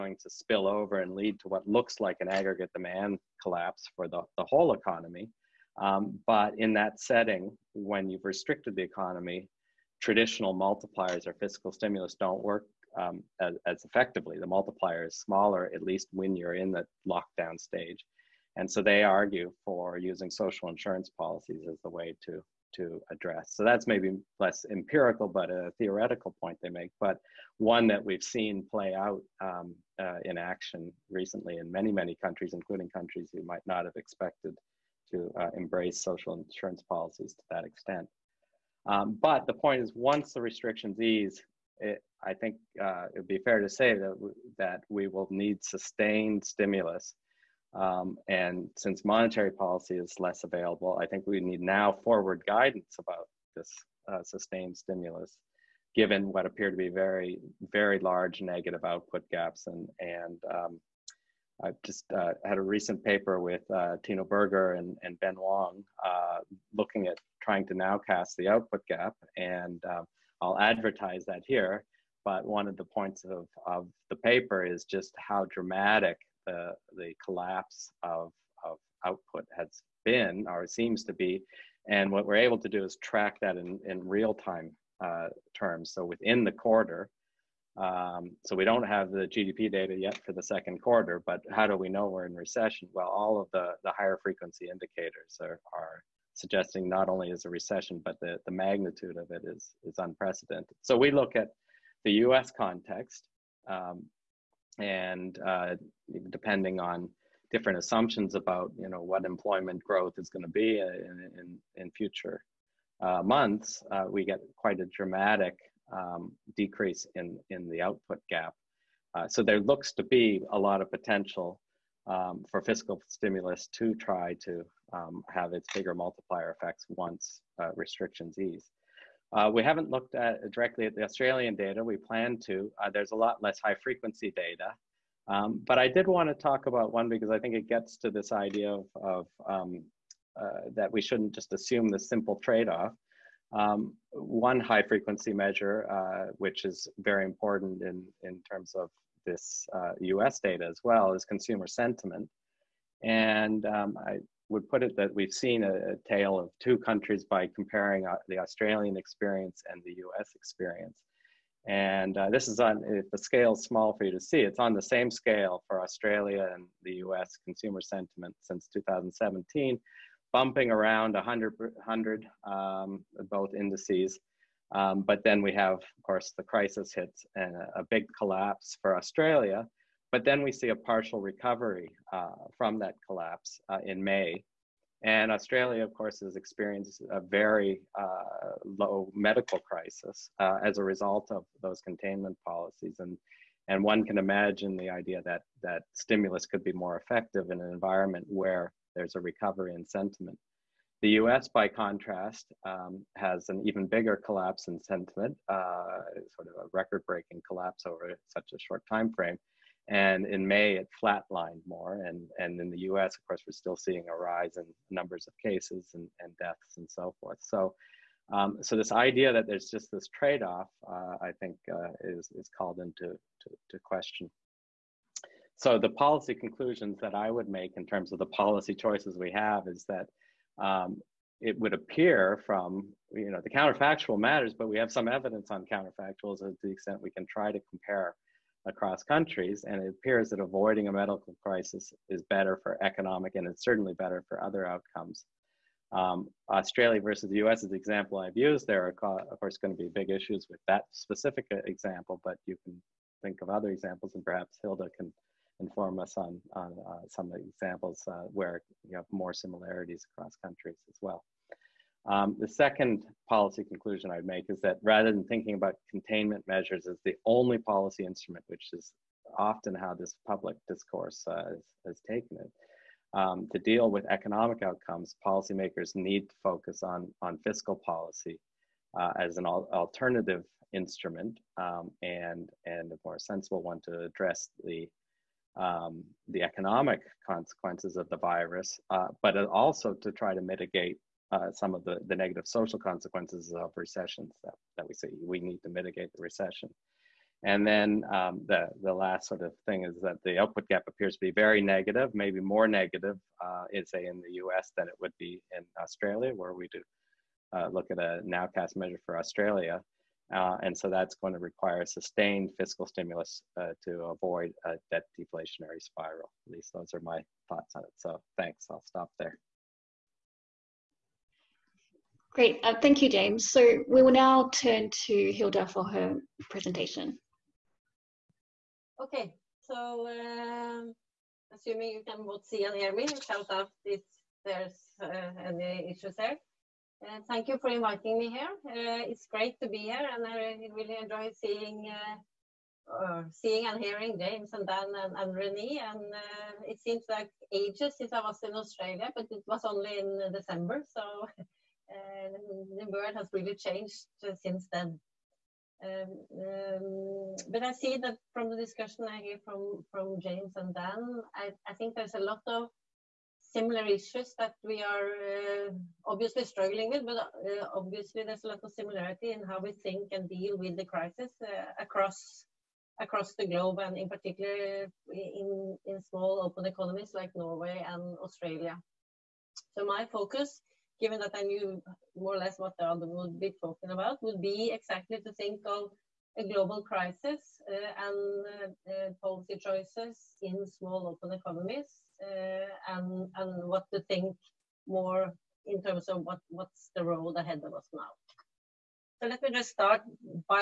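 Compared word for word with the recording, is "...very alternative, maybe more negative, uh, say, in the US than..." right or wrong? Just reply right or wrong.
wrong.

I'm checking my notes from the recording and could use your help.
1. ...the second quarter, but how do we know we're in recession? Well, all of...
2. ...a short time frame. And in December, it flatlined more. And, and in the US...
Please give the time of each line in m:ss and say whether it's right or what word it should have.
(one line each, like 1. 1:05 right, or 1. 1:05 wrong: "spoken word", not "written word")
1. 1:30 right
2. 3:28 wrong: "May", not "December".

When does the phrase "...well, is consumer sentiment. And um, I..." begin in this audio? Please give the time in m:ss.
2:30.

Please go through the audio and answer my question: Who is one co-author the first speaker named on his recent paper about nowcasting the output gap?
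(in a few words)
Tino Berger.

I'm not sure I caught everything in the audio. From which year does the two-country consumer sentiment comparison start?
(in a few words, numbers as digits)
2017.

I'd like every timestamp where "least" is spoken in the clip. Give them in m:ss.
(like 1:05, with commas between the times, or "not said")
0:15, 5:16.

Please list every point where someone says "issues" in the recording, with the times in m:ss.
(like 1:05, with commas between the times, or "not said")
4:10, 5:35, 6:03.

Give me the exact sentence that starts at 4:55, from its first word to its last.
We need to mitigate the recession.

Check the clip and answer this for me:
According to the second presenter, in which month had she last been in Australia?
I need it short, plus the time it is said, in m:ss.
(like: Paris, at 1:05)
December, at 5:50.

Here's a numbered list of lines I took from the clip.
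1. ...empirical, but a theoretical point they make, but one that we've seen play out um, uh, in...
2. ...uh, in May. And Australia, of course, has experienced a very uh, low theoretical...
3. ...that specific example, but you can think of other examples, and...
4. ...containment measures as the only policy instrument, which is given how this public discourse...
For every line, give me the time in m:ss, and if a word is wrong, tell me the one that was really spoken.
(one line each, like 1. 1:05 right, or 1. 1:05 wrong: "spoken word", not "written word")
1. 0:24 right
2. 3:03 wrong: "medical", not "theoretical"
3. 4:10 right
4. 4:25 wrong: "often", not "given".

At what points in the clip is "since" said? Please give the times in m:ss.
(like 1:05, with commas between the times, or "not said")
0:48, 2:48, 5:47, 5:54.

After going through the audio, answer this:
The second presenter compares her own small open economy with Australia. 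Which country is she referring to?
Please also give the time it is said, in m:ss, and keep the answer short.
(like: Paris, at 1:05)
Norway, at 6:17.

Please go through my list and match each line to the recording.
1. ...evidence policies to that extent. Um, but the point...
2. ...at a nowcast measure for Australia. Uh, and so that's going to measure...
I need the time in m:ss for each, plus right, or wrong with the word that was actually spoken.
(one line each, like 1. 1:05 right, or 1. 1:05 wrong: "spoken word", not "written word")
1. 0:36 wrong: "insurance", not "evidence"
2. 5:07 wrong: "require", not "measure".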